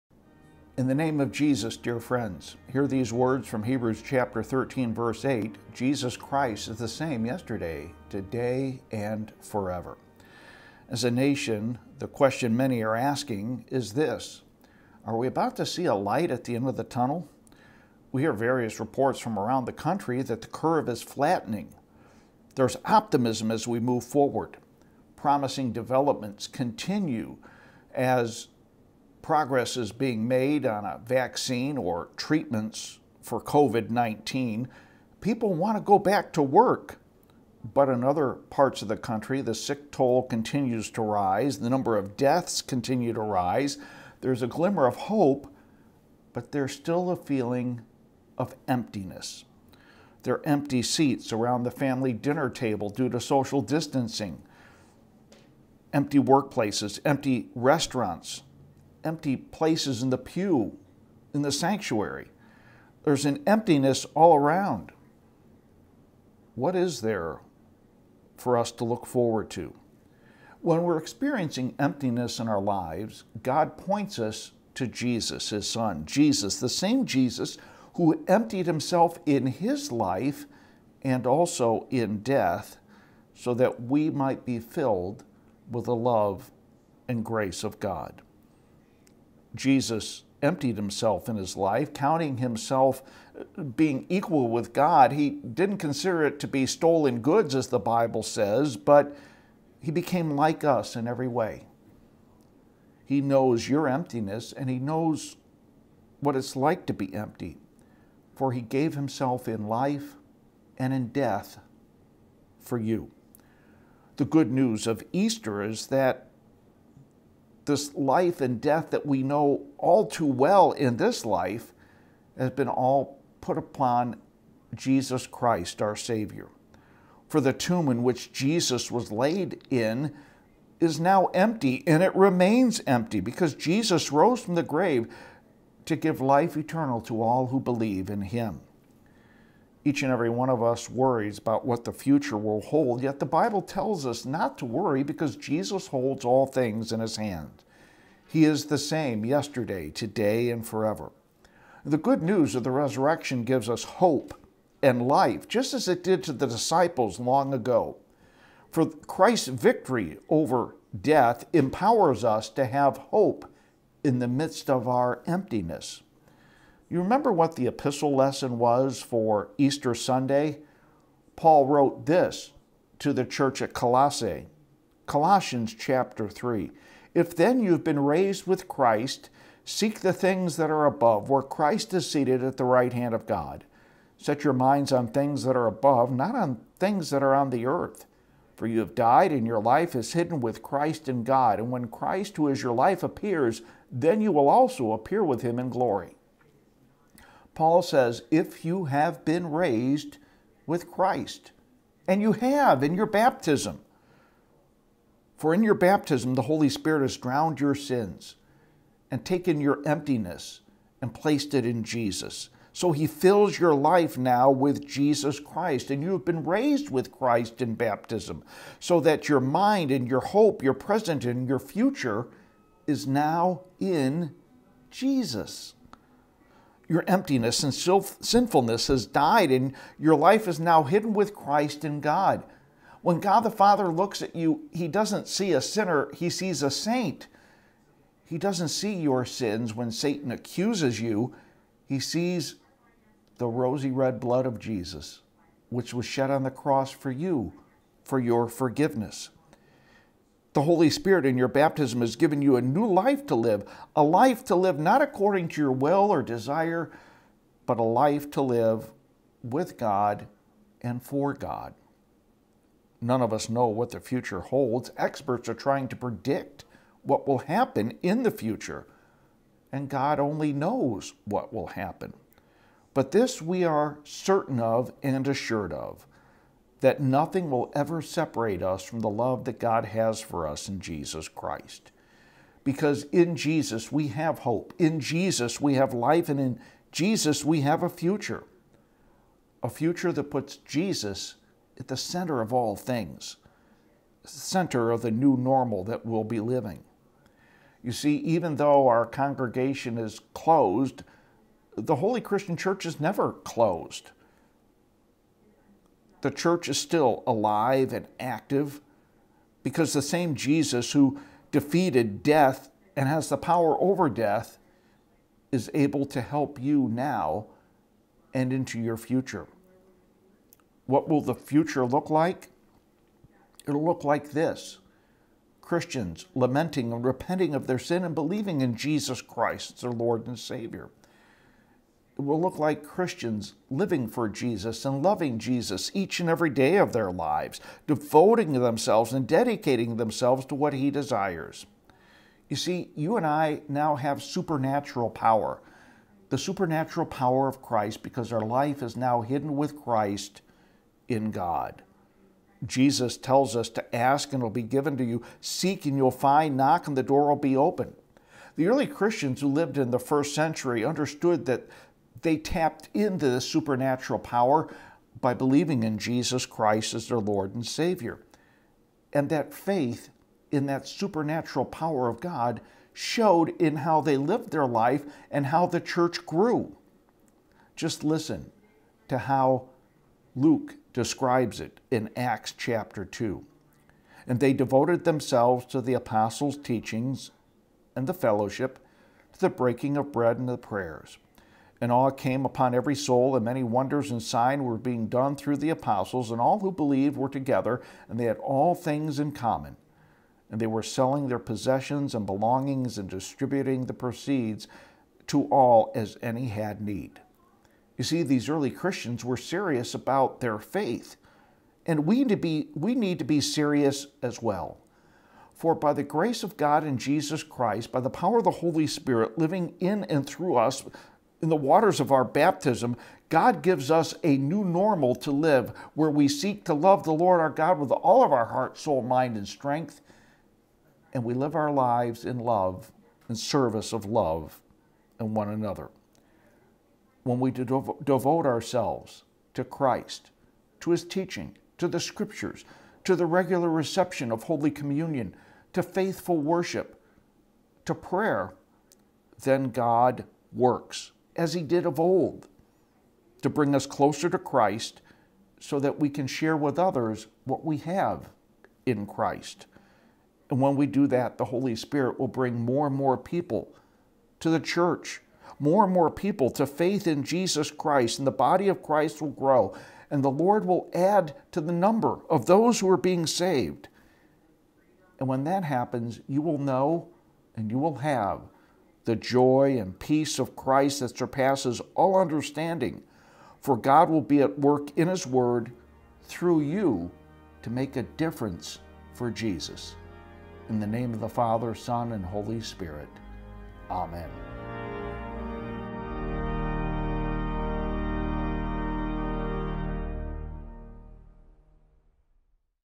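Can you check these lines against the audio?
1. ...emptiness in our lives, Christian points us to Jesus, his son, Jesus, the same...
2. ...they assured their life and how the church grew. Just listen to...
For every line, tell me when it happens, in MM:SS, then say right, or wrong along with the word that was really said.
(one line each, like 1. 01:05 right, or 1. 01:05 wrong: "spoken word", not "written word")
1. 01:11 wrong: "God", not "Christian"
2. 06:14 wrong: "lived", not "assured".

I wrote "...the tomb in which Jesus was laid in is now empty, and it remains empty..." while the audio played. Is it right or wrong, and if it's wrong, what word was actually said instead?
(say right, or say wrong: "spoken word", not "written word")
right.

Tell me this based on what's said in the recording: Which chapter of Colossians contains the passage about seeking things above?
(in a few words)
Chapter 3.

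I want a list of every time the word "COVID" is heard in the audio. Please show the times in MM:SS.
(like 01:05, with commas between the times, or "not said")
00:33.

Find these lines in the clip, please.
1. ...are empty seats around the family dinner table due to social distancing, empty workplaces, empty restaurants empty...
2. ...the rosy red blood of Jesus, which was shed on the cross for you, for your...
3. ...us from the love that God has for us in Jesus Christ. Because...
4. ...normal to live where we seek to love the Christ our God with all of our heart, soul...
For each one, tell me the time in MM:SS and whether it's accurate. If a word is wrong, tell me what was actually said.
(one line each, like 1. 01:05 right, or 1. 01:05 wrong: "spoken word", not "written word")
1. 00:50 right
2. 04:03 right
3. 04:38 right
4. 07:04 wrong: "Lord", not "Christ".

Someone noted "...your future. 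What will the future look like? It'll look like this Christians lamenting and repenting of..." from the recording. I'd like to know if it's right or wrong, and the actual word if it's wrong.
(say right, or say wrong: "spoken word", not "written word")
right.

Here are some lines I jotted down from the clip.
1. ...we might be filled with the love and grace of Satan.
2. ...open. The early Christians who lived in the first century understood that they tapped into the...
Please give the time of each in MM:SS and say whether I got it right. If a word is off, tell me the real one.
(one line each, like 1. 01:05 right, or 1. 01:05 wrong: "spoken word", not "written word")
1. 01:23 wrong: "God", not "Satan"
2. 05:57 right.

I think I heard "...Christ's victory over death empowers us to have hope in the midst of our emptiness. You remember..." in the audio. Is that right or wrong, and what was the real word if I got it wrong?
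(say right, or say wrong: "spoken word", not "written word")
right.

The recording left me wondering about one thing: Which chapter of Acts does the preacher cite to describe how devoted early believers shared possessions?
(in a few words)
Chapter 2.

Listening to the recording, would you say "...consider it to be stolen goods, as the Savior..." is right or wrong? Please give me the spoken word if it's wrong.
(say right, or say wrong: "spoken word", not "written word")
wrong: "Bible", not "Savior".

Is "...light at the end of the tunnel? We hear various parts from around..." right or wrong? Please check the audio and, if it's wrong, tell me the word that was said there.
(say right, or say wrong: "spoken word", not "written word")
wrong: "reports", not "parts".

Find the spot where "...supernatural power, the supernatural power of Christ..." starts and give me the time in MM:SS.
05:44.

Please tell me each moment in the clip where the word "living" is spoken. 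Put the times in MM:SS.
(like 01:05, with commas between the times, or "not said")
04:56, 05:33, 06:59.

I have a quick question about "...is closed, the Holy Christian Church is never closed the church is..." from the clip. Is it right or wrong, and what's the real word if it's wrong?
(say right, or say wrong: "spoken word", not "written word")
right.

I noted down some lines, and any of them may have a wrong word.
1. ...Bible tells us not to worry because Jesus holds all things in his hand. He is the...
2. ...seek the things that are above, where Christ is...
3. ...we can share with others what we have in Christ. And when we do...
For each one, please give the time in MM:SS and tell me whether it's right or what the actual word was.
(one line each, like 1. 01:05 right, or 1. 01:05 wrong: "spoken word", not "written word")
1. 02:23 right
2. 02:59 right
3. 07:35 right.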